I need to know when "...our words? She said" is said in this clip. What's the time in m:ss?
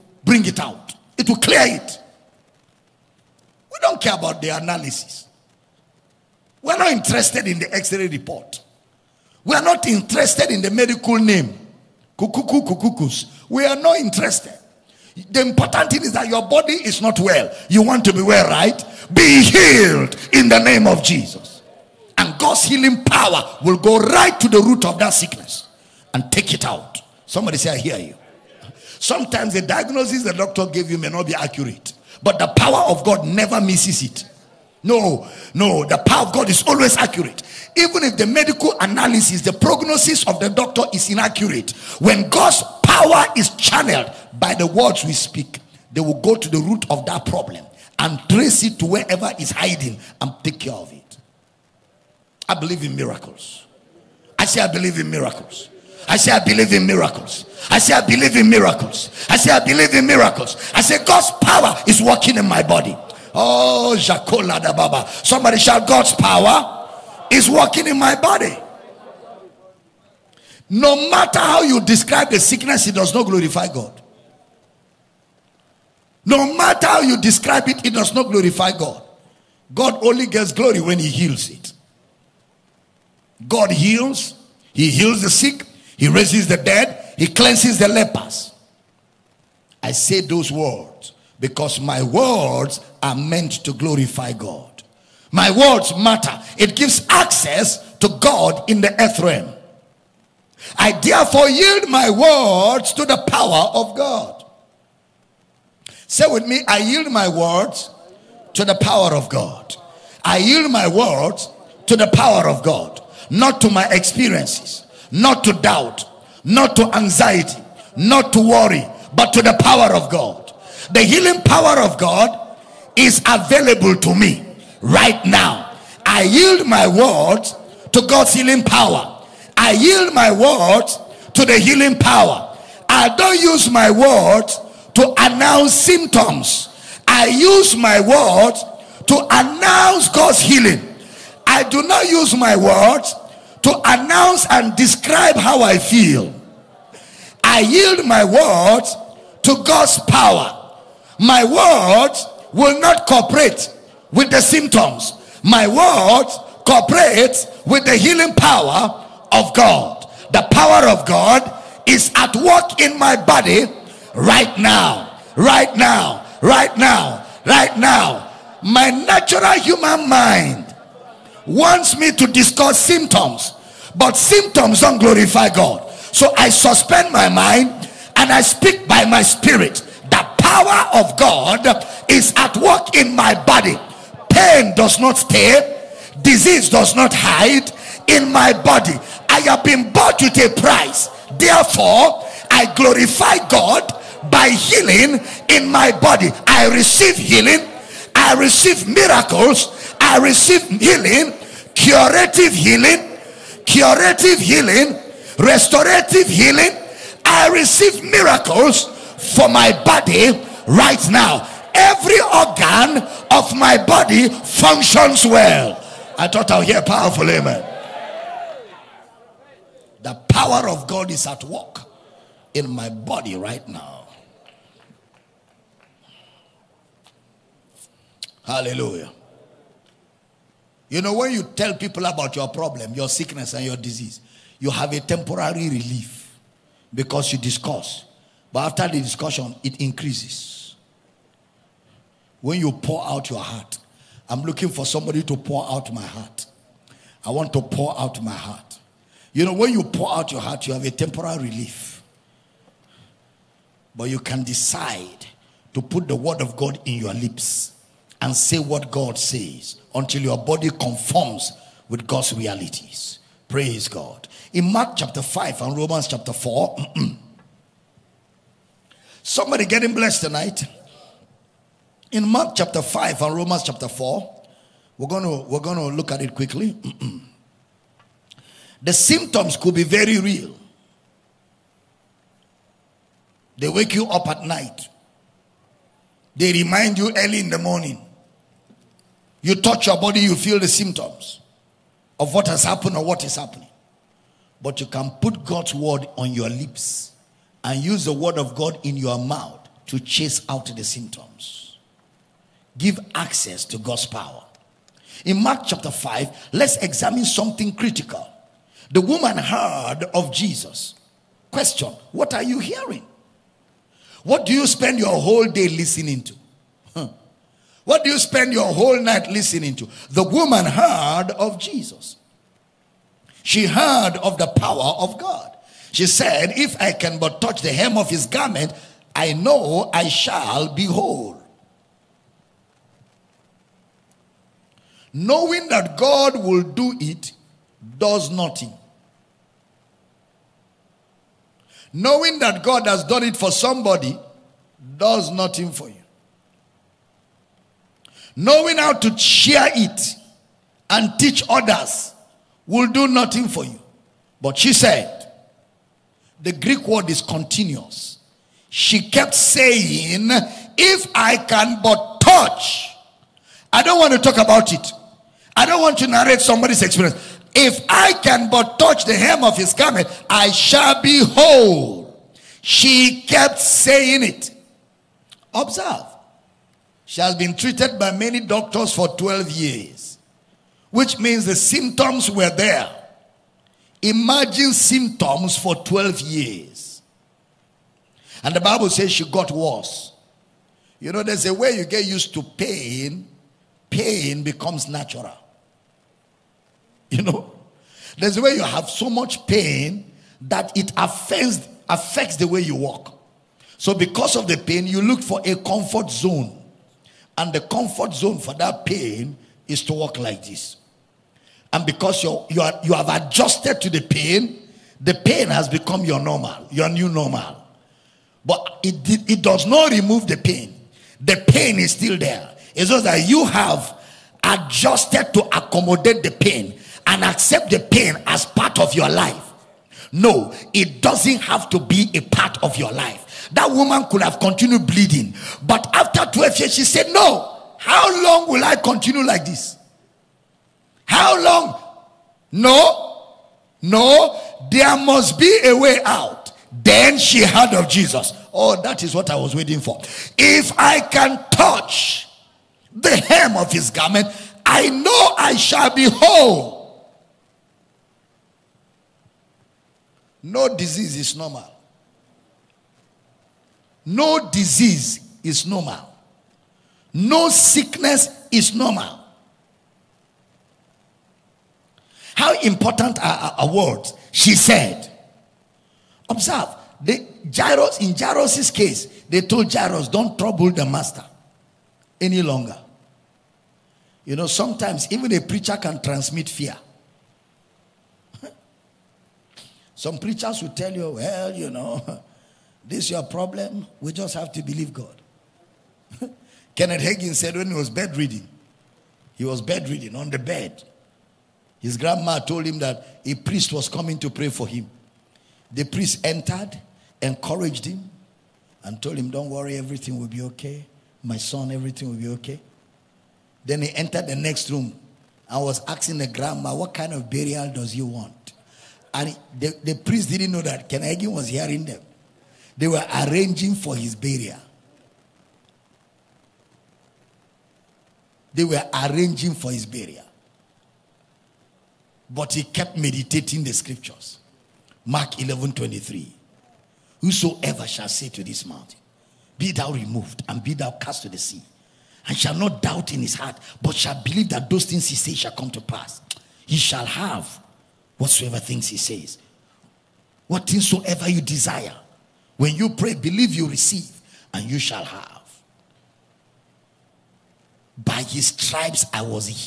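7:53.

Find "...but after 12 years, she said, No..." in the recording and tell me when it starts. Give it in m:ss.
7:15.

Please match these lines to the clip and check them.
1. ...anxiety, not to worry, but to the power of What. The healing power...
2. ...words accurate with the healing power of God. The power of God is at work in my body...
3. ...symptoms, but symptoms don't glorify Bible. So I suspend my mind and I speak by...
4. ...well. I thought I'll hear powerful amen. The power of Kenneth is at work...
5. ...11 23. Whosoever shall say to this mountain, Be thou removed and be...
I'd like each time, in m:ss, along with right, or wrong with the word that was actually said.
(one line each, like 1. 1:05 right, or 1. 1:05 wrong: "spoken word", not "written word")
1. 1:56 wrong: "God", not "What"
2. 2:35 wrong: "cooperate", not "accurate"
3. 2:52 wrong: "God", not "Bible"
4. 3:35 wrong: "God", not "Kenneth"
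5. 8:55 right.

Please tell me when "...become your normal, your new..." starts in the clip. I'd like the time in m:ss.
6:55.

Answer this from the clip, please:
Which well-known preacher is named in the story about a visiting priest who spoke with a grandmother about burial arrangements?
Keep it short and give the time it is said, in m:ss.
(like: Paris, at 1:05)
Kenneth Hagin, at 8:16.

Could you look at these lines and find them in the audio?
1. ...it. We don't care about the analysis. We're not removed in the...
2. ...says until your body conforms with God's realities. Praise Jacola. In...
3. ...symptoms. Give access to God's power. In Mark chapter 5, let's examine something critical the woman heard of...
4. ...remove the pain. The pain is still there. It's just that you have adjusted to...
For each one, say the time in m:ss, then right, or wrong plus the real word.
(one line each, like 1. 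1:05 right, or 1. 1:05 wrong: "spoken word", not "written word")
1. 0:01 wrong: "interested", not "removed"
2. 4:19 wrong: "God", not "Jacola"
3. 5:00 right
4. 6:59 right.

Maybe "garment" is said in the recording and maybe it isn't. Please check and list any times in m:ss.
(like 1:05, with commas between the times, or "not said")
5:28, 6:09, 7:33.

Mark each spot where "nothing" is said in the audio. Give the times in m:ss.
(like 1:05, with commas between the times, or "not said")
5:38, 5:45, 5:53.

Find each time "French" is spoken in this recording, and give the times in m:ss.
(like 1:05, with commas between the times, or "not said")
not said.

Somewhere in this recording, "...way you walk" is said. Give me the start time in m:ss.
6:42.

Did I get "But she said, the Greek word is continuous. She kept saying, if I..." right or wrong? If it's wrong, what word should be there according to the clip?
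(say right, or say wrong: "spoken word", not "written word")
right.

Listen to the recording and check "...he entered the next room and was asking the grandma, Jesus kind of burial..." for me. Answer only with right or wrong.
wrong.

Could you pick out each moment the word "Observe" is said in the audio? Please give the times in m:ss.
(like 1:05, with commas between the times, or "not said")
6:15, 7:56.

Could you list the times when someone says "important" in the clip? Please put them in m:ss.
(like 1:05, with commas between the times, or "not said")
0:15, 7:52.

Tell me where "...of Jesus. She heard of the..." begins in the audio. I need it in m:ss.
5:21.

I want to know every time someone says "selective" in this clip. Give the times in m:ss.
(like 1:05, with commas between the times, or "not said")
not said.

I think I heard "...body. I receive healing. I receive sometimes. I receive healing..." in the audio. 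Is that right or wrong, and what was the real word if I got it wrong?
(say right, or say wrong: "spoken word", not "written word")
wrong: "miracles", not "sometimes".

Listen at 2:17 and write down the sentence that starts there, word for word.
I use my words to announce God's healing.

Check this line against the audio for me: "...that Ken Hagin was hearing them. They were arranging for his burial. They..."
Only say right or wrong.
right.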